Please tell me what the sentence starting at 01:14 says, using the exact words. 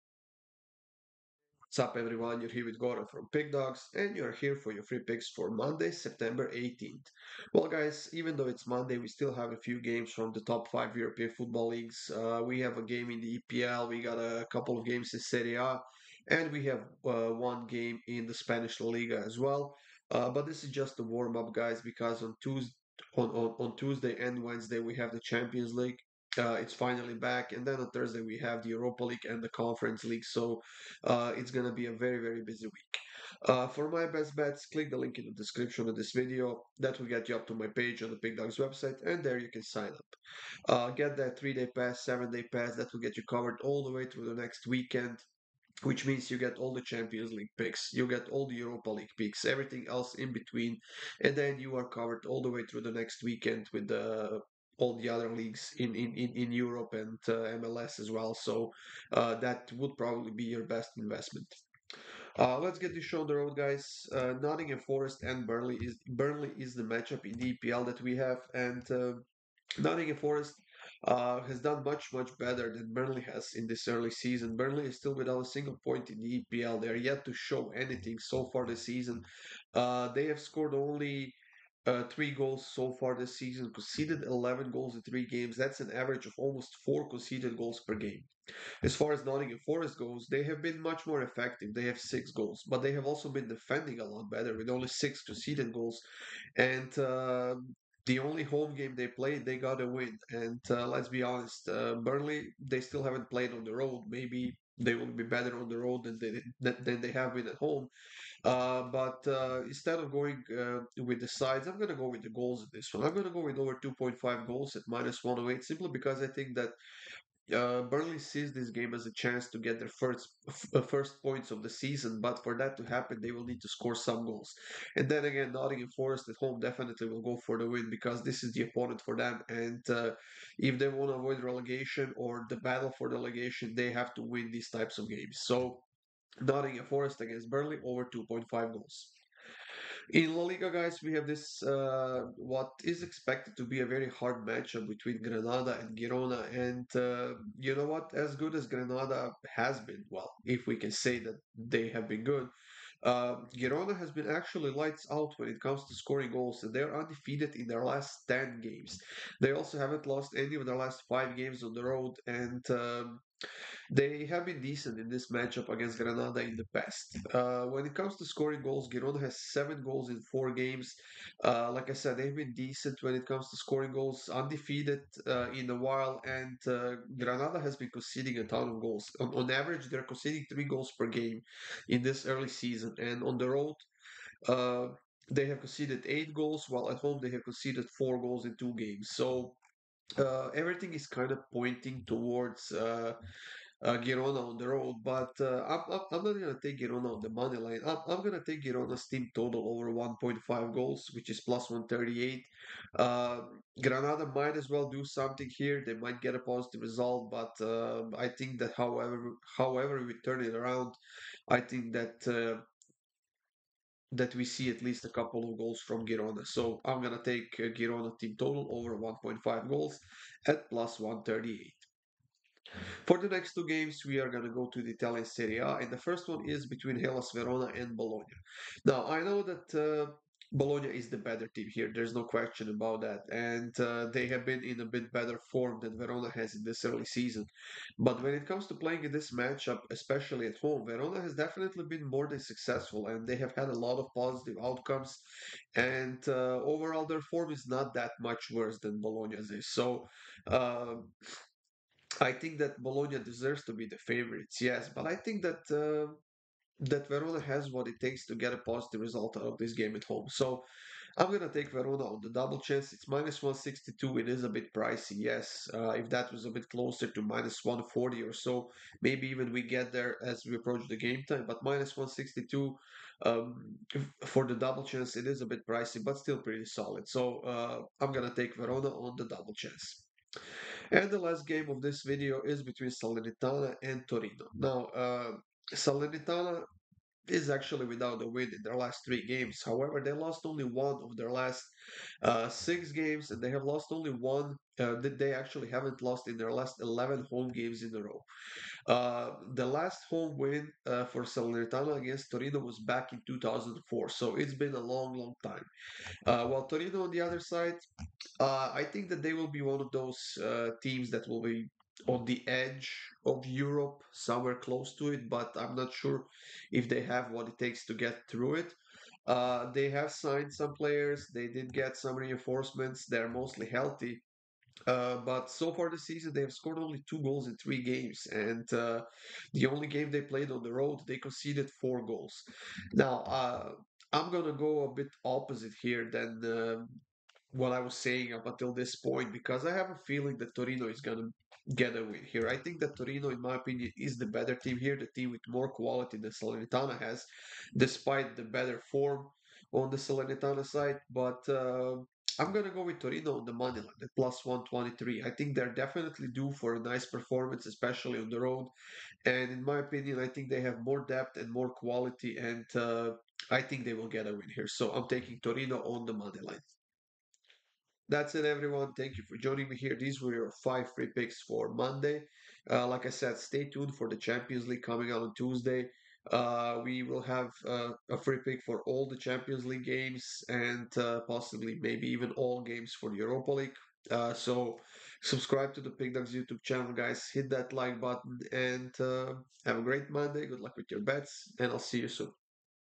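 Burnley is still without a single point in the EPL.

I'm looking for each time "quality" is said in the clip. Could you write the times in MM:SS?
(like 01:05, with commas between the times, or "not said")
05:45, 06:01.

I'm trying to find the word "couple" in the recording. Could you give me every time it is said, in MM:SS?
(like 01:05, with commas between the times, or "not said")
00:14, 03:35.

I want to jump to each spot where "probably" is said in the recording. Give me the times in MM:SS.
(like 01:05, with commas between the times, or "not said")
00:59.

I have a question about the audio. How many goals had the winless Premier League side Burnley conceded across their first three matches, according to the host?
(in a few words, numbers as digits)
11.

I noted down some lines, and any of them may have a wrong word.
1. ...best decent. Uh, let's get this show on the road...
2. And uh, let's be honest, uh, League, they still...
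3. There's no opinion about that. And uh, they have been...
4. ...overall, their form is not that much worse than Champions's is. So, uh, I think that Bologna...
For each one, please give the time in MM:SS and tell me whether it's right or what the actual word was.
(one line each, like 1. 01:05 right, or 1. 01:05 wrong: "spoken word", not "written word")
1. 01:00 wrong: "investment", not "decent"
2. 01:40 wrong: "Burnley", not "League"
3. 03:51 wrong: "question", not "opinion"
4. 04:06 wrong: "Bologna", not "Champions".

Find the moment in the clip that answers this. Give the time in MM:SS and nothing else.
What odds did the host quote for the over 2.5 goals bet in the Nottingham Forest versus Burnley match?
01:54.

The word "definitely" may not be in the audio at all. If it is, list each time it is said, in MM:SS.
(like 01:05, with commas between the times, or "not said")
02:06, 04:01, 05:55.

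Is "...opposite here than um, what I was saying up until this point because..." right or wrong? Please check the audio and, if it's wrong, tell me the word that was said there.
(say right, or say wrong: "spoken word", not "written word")
right.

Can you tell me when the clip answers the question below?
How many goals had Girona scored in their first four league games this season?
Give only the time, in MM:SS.
02:49.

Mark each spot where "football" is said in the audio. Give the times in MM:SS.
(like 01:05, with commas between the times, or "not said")
00:11.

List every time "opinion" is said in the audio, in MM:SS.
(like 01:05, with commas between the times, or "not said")
05:43, 05:59.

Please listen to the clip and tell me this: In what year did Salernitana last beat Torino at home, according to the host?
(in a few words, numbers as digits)
2004.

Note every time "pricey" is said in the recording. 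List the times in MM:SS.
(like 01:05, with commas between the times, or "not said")
04:24, 04:35.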